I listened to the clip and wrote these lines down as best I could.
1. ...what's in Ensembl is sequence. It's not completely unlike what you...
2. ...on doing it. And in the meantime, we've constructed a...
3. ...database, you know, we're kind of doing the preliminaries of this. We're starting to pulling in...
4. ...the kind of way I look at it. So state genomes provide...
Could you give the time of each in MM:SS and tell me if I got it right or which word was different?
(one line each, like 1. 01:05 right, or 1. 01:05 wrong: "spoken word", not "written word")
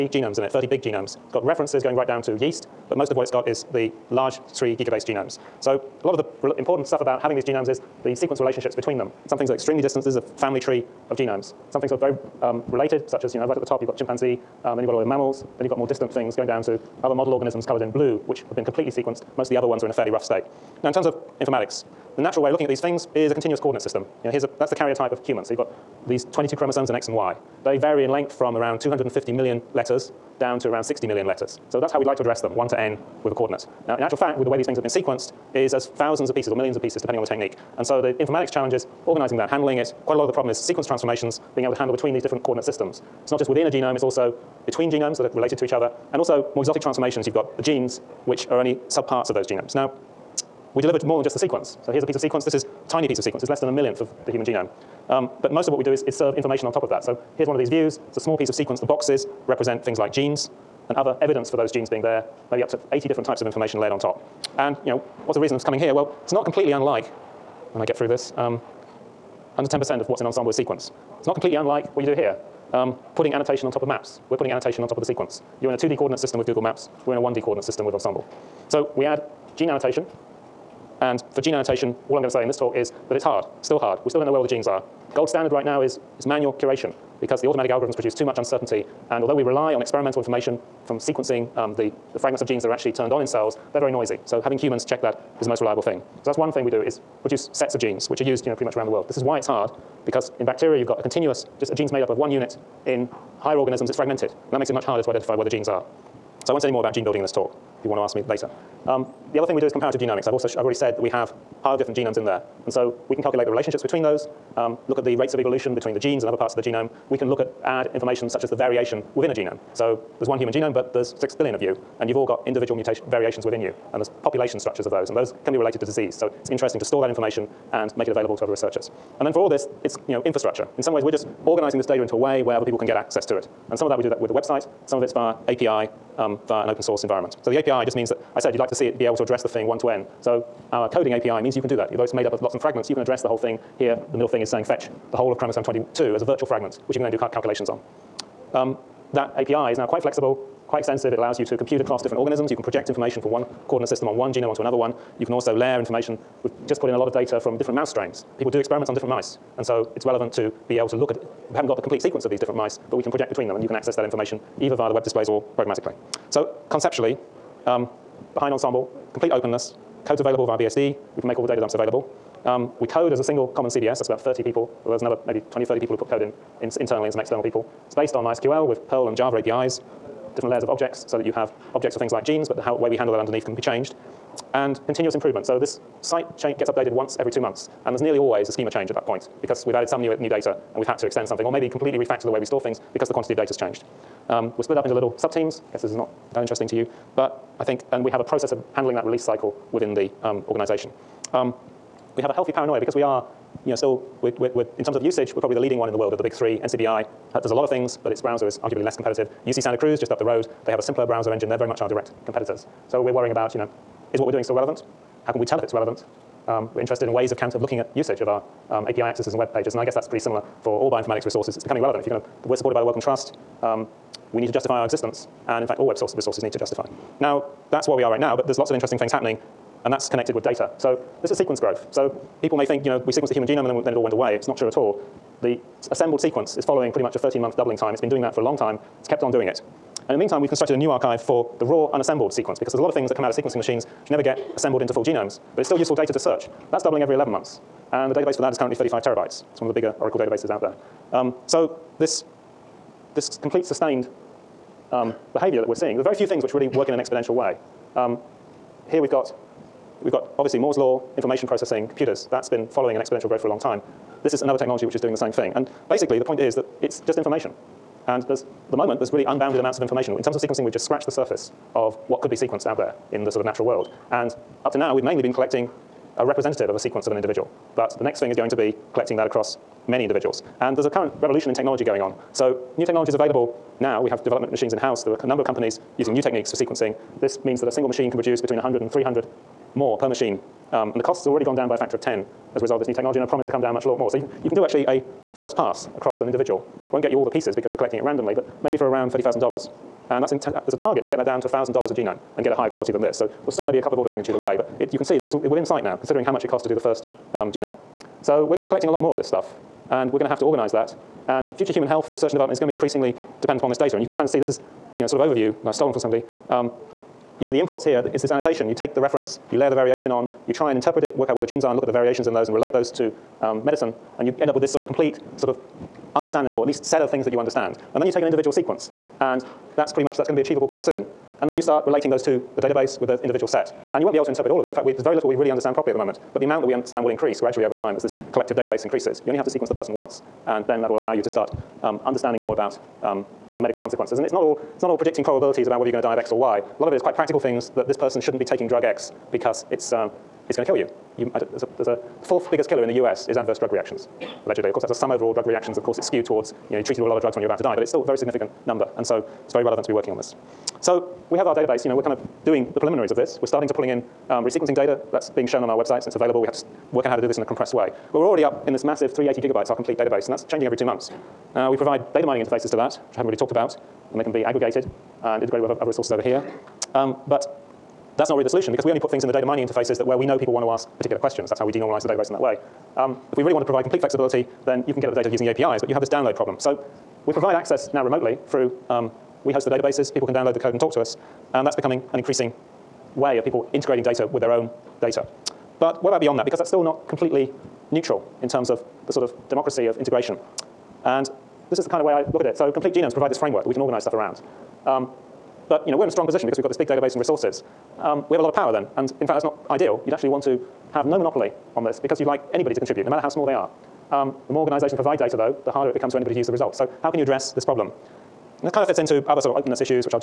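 1. 01:10 right
2. 03:59 right
3. 06:01 right
4. 06:41 wrong: "complete", not "state".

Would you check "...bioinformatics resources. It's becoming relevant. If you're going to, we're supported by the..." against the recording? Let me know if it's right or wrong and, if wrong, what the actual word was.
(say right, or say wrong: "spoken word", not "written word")
right.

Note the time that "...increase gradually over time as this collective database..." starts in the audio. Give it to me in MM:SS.
05:37.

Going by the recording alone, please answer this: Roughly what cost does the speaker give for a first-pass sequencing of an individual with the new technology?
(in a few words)
$30,000.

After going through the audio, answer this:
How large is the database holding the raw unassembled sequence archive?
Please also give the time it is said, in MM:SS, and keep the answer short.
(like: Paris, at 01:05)
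35 terabytes, at 04:08.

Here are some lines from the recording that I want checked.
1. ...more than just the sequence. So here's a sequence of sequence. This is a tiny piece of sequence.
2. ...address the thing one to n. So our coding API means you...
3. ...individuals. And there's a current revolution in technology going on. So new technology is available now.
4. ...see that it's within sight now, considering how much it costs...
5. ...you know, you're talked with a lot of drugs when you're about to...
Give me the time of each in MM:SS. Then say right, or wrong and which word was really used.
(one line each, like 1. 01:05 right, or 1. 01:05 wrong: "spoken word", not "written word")
1. 00:51 wrong: "piece", not "sequence"
2. 02:19 right
3. 04:40 right
4. 05:05 right
5. 05:56 wrong: "treated", not "talked".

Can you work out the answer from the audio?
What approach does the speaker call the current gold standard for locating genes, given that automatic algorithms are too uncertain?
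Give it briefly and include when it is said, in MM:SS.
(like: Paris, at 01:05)
manual curation, at 01:26.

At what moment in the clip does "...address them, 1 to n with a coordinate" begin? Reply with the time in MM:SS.
00:32.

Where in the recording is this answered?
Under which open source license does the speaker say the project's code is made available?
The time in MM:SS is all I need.
02:50.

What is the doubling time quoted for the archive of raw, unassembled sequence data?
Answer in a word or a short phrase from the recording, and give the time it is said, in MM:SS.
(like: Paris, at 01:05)
11 months, at 04:07.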